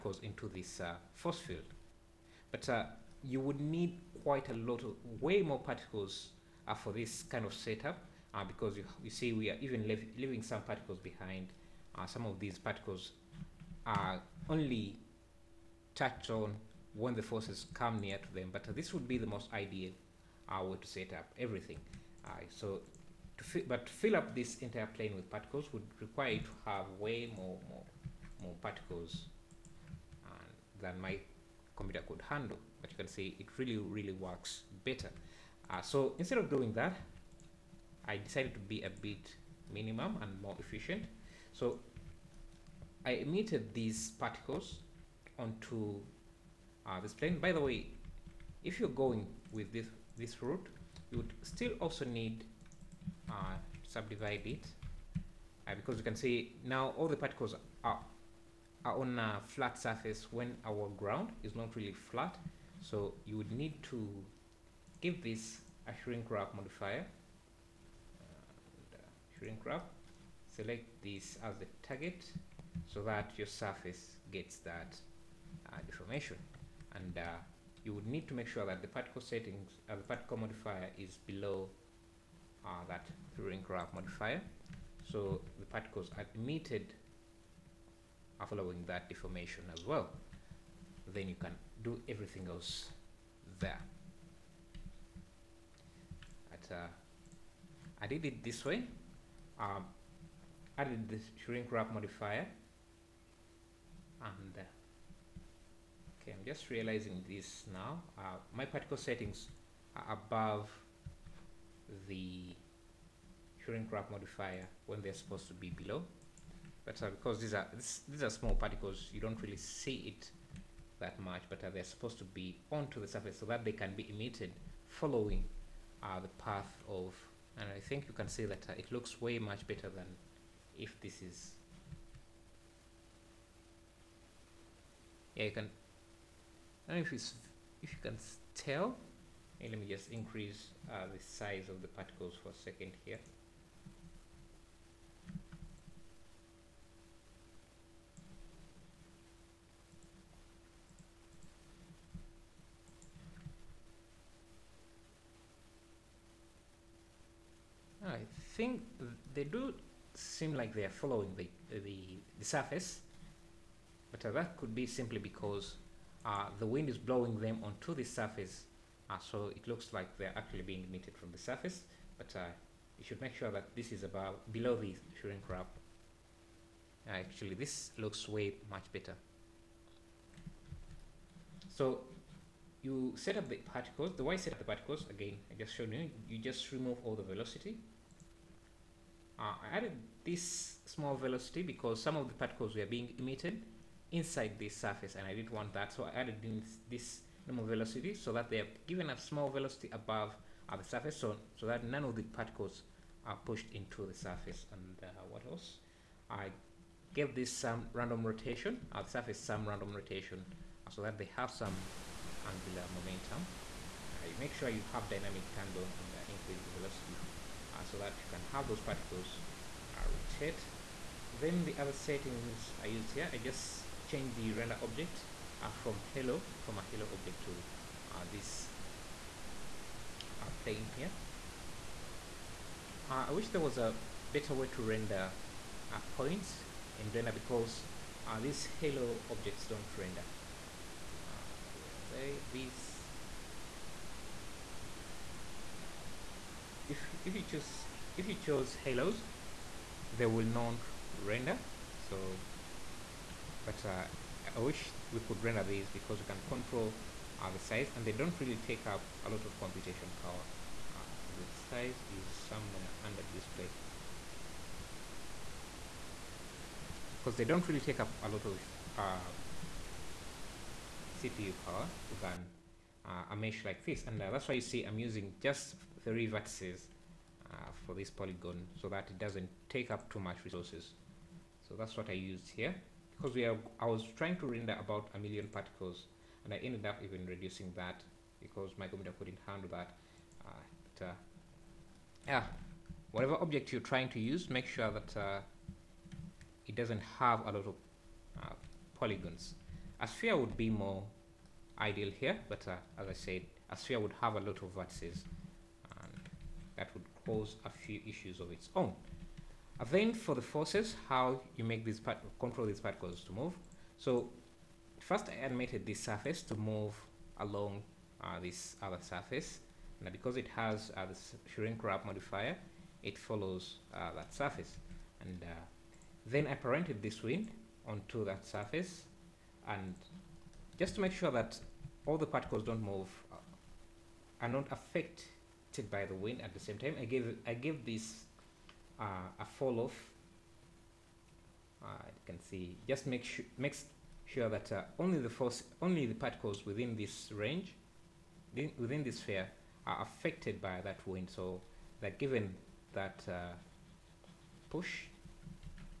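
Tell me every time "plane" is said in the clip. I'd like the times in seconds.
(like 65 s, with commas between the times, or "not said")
24 s, 47 s, 230 s.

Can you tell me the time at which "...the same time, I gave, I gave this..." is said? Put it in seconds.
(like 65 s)
336 s.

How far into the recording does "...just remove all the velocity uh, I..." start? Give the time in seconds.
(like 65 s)
186 s.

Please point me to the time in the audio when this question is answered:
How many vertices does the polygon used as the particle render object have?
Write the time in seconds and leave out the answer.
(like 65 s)
276 s.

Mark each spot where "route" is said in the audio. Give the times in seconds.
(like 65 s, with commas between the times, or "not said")
50 s.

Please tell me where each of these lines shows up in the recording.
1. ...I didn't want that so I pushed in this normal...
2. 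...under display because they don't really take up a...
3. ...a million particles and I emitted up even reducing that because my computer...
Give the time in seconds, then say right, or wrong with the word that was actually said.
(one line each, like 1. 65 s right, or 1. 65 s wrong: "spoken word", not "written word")
1. 195 s wrong: "added", not "pushed"
2. 263 s right
3. 285 s wrong: "ended", not "emitted".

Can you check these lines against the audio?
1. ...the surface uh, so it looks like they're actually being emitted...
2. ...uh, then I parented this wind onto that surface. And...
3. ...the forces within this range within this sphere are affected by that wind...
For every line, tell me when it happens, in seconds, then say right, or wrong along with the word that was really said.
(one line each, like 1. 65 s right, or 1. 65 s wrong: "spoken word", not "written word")
1. 167 s right
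2. 325 s right
3. 346 s wrong: "particles", not "forces".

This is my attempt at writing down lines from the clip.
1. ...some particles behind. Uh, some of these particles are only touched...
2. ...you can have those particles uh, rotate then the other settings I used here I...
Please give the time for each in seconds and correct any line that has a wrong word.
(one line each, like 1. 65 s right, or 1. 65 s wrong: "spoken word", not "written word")
1. 10 s right
2. 218 s right.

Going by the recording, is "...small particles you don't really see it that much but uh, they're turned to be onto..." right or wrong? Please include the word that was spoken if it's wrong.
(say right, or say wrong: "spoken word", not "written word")
wrong: "supposed", not "turned".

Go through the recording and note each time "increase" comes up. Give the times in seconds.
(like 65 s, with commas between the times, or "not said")
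140 s, 216 s.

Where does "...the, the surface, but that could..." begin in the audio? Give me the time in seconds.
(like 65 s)
161 s.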